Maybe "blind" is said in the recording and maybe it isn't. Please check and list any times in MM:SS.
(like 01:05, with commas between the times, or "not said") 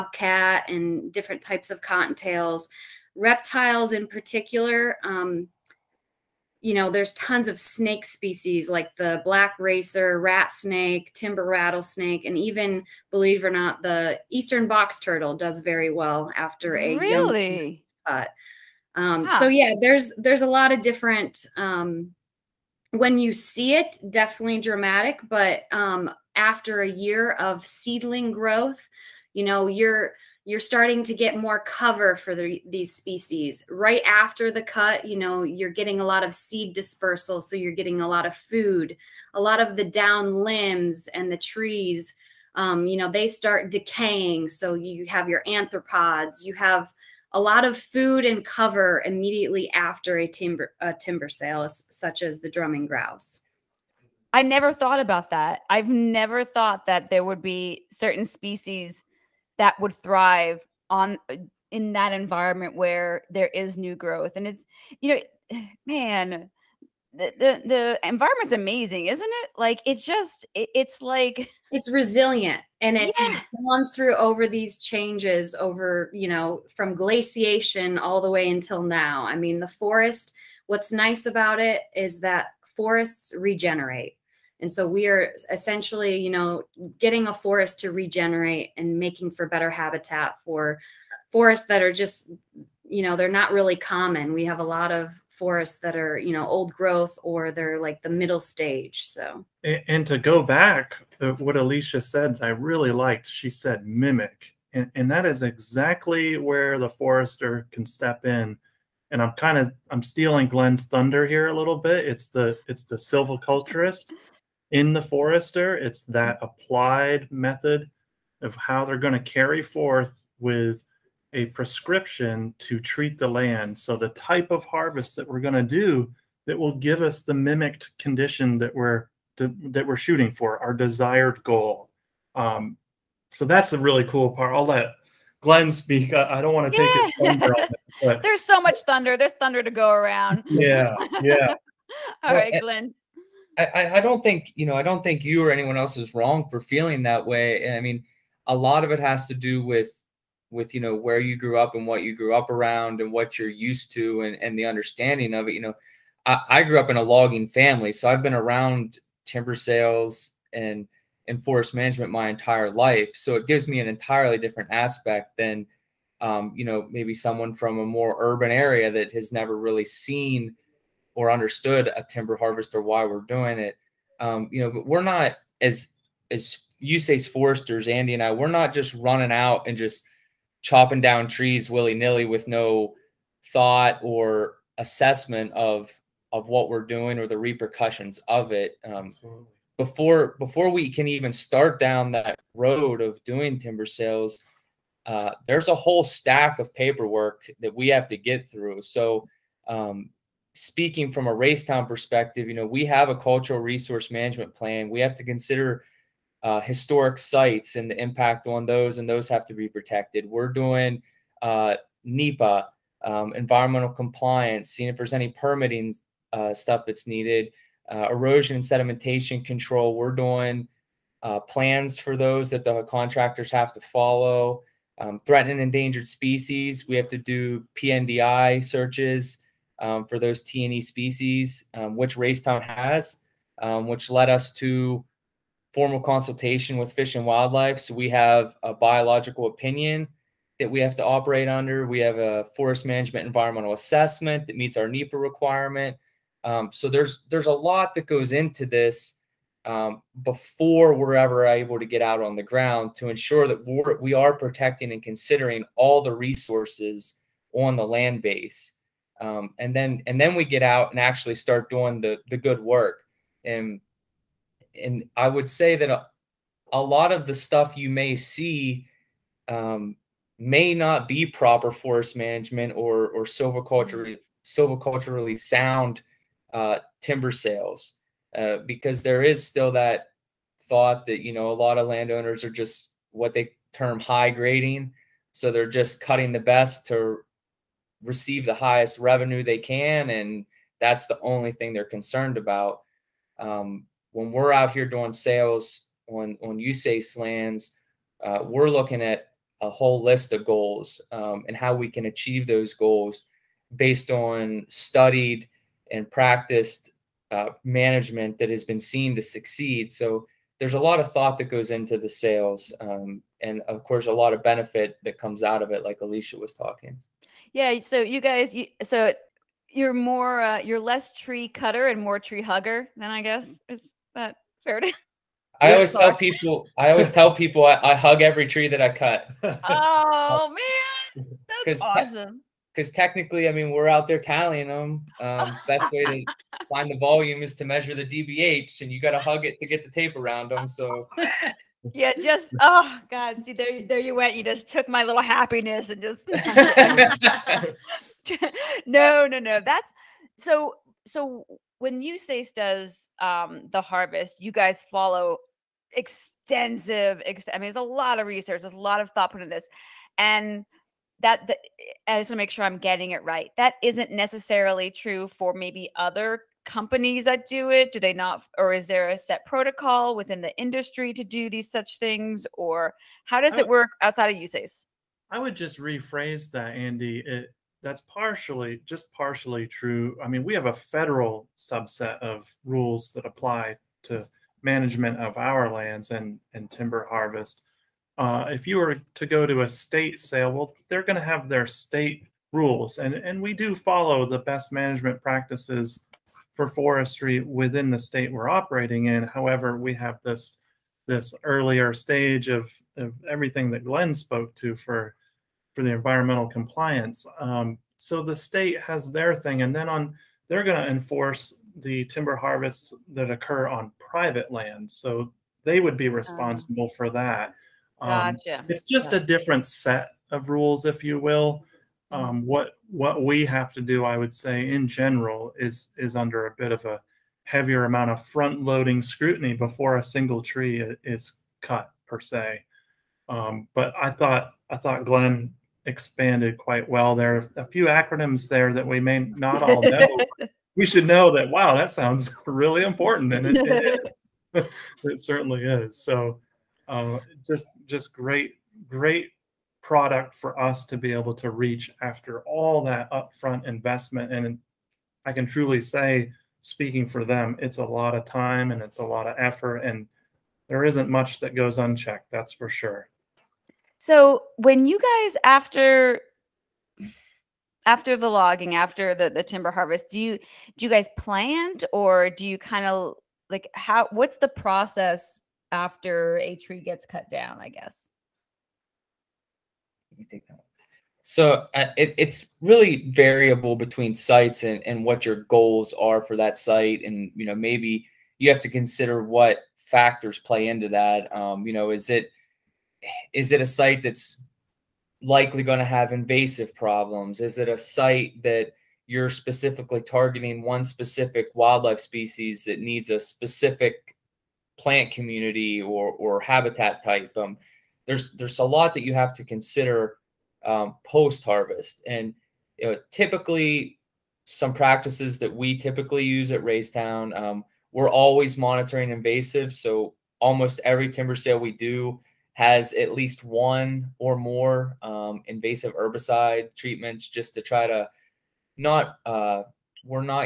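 not said.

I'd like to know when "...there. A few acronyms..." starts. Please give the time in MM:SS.
07:17.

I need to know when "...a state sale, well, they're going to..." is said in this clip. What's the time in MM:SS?
06:29.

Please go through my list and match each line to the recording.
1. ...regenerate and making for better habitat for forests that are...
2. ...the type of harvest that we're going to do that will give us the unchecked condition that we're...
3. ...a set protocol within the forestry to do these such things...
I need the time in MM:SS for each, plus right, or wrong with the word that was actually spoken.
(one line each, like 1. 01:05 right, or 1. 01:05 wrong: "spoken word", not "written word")
1. 01:27 right
2. 02:03 wrong: "mimicked", not "unchecked"
3. 06:09 wrong: "industry", not "forestry".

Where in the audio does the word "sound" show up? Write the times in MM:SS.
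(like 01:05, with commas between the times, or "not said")
04:35, 07:21.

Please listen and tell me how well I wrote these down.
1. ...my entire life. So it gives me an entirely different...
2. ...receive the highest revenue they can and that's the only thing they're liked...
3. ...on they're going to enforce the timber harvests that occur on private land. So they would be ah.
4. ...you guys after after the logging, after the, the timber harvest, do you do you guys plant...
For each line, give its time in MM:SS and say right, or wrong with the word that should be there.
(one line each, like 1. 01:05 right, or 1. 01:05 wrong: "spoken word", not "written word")
1. 02:42 right
2. 04:48 wrong: "concerned", not "liked"
3. 06:49 right
4. 07:44 right.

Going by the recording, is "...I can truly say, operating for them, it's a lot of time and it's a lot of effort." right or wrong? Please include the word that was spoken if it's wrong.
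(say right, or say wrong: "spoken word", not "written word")
wrong: "speaking", not "operating".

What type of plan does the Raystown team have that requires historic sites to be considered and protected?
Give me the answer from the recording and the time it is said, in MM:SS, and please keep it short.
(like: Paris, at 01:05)
Cultural resource management plan, at 03:23.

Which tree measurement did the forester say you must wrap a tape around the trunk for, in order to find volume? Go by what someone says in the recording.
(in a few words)
DBH.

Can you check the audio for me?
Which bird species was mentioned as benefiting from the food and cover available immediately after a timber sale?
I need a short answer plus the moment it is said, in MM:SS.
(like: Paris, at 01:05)
Drumming grouse, at 00:52.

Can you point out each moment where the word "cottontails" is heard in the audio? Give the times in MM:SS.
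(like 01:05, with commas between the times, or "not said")
00:01.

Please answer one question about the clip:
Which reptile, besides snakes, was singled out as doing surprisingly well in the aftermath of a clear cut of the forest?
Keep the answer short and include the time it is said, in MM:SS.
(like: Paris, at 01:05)
Eastern box turtle, at 00:14.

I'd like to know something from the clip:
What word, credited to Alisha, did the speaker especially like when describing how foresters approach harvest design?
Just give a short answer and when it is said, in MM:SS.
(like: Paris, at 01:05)
Mimic, at 01:43.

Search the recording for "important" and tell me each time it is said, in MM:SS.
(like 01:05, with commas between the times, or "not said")
07:22.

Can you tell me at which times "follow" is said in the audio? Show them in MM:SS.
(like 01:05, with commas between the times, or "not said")
03:43, 05:54, 06:33.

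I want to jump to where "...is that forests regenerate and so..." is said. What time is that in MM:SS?
01:21.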